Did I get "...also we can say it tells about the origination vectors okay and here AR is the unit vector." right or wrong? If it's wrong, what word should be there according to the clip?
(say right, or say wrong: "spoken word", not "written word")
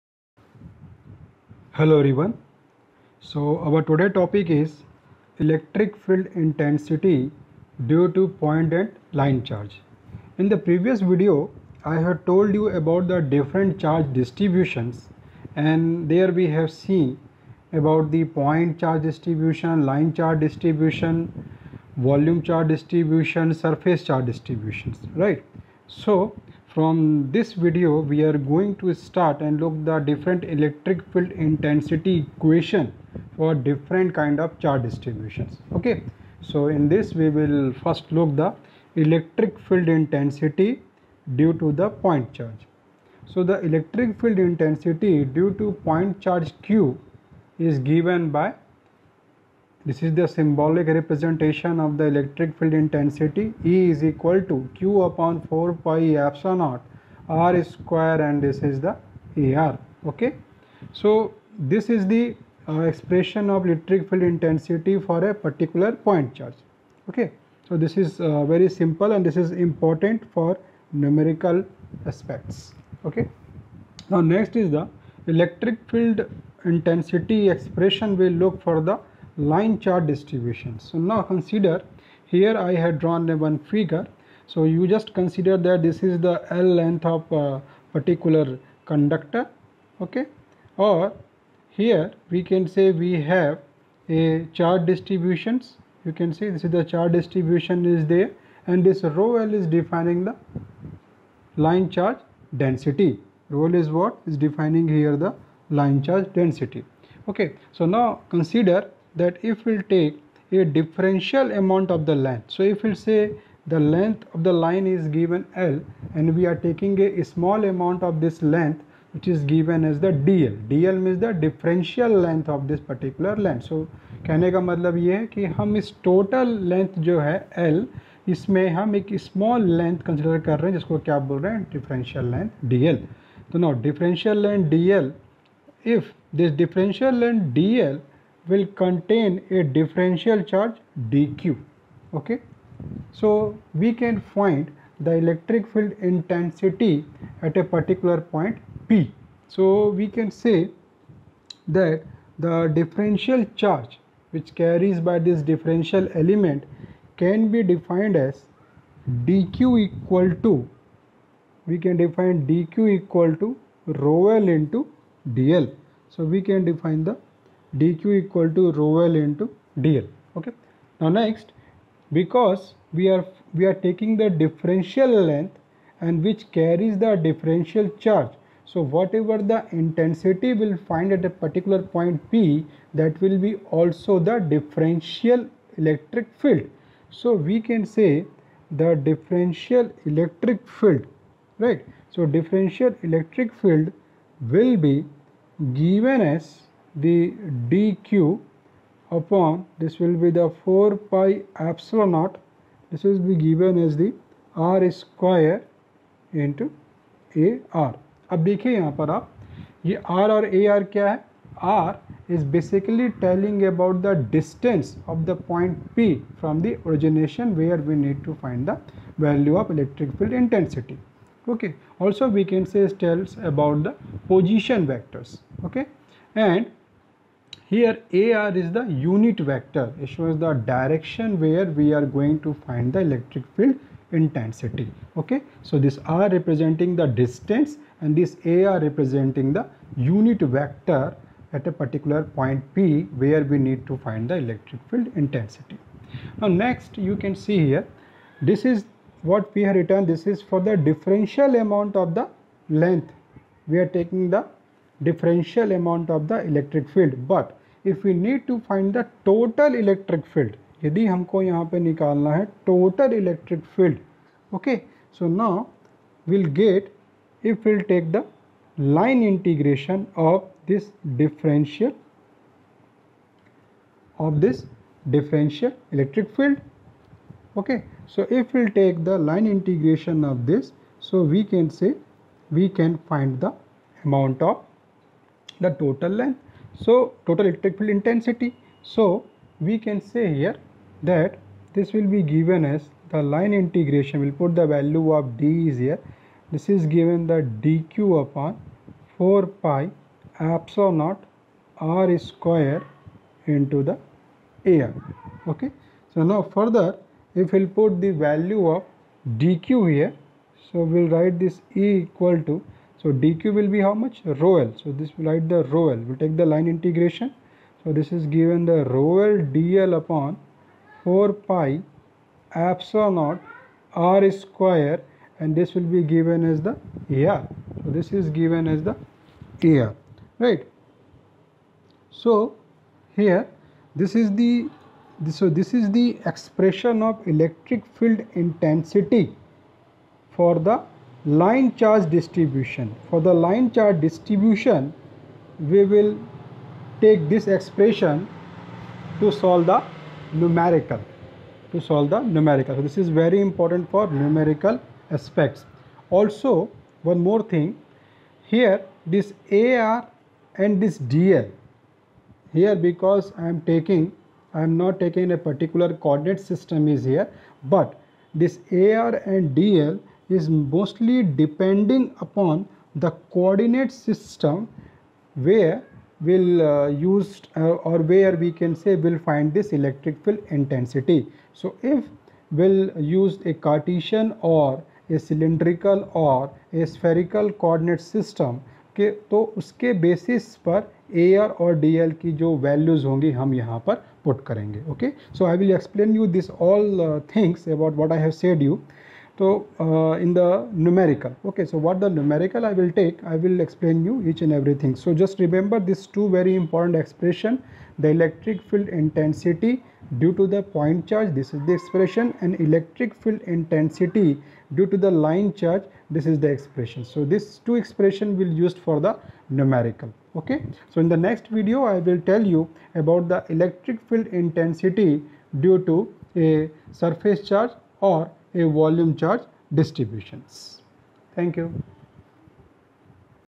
wrong: "position", not "origination".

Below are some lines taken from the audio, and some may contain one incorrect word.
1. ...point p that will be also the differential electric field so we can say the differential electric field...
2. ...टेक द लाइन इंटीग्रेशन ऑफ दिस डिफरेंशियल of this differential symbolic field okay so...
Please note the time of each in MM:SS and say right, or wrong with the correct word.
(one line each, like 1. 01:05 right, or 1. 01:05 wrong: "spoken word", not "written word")
1. 03:01 right
2. 04:27 wrong: "electric", not "symbolic".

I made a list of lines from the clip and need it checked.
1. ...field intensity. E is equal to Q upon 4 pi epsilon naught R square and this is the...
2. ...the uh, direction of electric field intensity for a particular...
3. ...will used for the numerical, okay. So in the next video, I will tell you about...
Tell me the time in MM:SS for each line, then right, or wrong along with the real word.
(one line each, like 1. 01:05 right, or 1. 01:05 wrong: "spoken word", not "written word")
1. 00:52 right
2. 01:02 wrong: "expression", not "direction"
3. 06:58 right.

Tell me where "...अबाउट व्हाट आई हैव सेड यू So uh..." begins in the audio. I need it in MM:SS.
06:37.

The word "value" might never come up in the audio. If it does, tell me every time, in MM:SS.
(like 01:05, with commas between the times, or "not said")
03:39, 04:54, 05:08.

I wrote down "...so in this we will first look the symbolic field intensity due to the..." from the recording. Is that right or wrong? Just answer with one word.
wrong.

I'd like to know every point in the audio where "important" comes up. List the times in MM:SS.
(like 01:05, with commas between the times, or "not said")
01:09, 05:53, 06:46.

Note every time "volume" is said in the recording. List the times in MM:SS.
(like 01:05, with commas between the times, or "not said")
00:22, 07:08.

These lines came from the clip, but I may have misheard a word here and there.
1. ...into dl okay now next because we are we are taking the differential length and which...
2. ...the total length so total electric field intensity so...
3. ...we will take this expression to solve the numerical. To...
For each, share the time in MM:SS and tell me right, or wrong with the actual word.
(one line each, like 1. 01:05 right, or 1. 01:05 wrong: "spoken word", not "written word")
1. 02:49 right
2. 04:45 right
3. 05:45 right.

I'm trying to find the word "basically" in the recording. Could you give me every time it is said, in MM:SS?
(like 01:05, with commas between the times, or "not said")
03:32.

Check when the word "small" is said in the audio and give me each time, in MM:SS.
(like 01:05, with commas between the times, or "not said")
01:57, 02:09.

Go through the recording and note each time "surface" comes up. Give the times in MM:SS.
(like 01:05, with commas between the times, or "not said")
00:23, 07:06.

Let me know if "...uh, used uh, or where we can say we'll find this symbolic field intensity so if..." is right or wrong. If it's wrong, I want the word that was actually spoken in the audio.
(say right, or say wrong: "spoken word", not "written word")
wrong: "electric", not "symbolic".